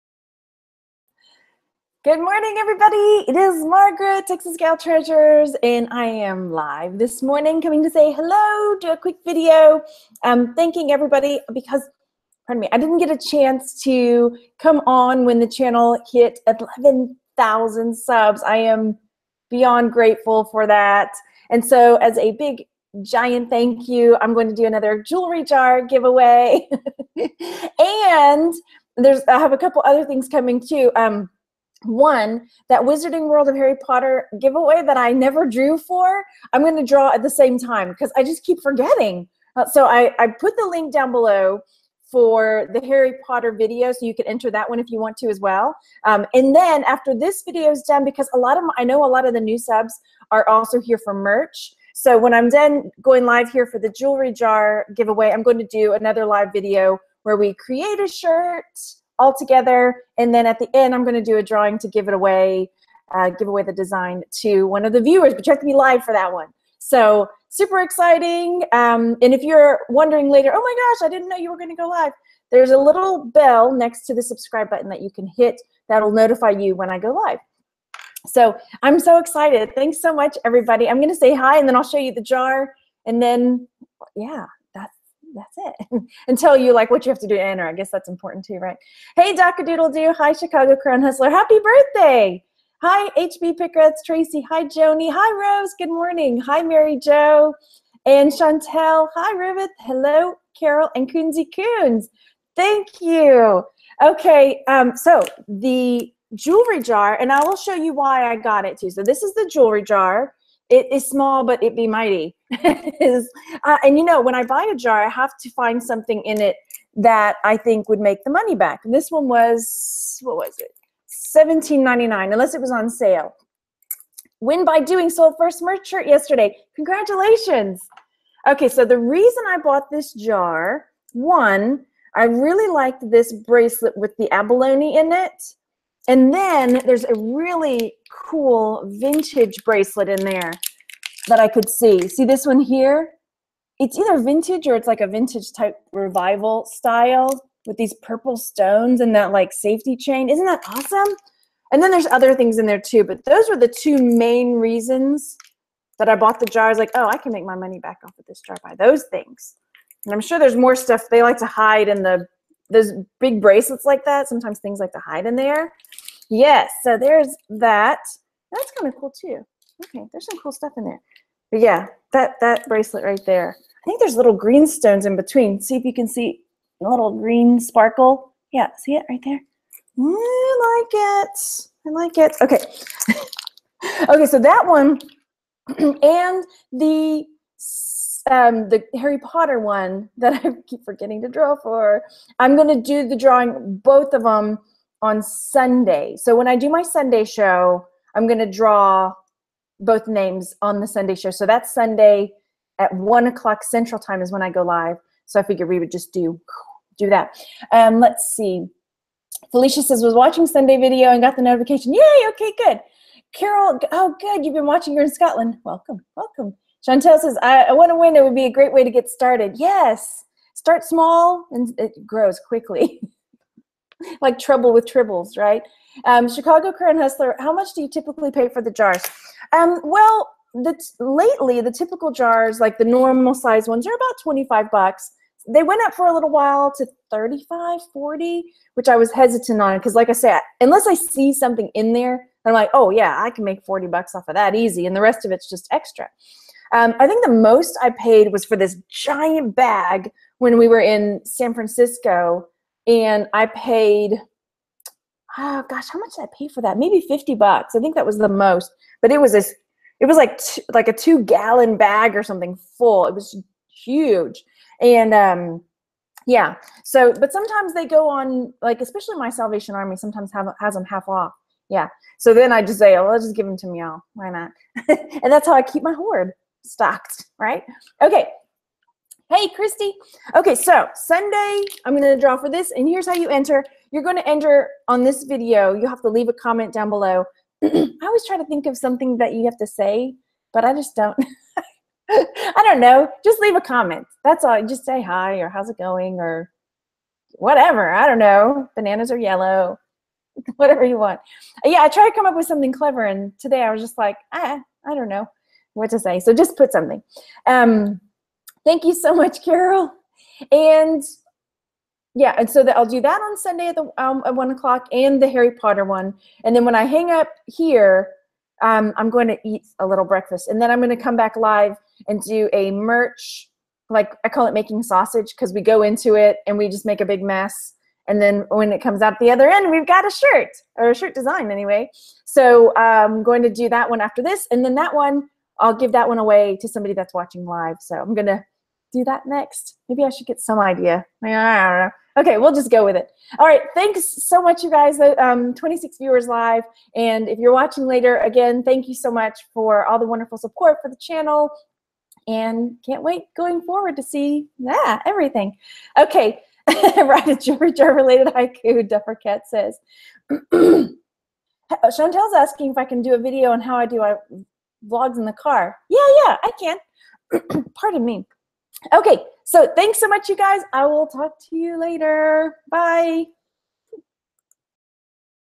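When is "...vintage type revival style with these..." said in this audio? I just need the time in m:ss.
2:25.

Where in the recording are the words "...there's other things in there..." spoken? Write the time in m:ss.
2:31.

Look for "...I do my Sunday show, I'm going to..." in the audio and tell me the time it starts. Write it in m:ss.
3:16.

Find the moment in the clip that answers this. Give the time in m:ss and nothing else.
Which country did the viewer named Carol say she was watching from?
3:35.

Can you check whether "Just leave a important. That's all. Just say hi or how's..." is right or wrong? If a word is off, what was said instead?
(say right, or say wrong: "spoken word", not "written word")
wrong: "comment", not "important".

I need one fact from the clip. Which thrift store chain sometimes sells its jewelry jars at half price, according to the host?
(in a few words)
Salvation Army.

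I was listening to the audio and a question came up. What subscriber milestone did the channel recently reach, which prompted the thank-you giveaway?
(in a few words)
11,000.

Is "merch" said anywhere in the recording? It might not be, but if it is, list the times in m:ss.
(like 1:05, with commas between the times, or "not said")
0:51, 2:05, 5:22.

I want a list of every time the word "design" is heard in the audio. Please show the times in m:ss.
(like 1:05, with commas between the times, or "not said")
1:03, 5:31.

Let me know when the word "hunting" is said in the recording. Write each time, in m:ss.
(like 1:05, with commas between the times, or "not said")
not said.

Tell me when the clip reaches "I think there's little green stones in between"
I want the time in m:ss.
2:53.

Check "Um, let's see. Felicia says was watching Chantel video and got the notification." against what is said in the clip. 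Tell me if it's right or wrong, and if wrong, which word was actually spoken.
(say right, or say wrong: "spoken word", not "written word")
wrong: "Sunday", not "Chantel".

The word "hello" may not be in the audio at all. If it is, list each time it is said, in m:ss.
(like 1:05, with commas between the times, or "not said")
0:08, 1:39.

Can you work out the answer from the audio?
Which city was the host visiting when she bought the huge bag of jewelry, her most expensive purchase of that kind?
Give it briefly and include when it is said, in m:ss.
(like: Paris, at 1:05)
San Francisco, at 4:11.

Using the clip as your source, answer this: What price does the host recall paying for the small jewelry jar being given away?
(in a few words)
$17.99.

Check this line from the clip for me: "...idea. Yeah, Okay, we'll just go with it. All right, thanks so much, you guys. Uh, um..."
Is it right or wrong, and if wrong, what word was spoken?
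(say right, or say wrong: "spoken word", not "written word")
right.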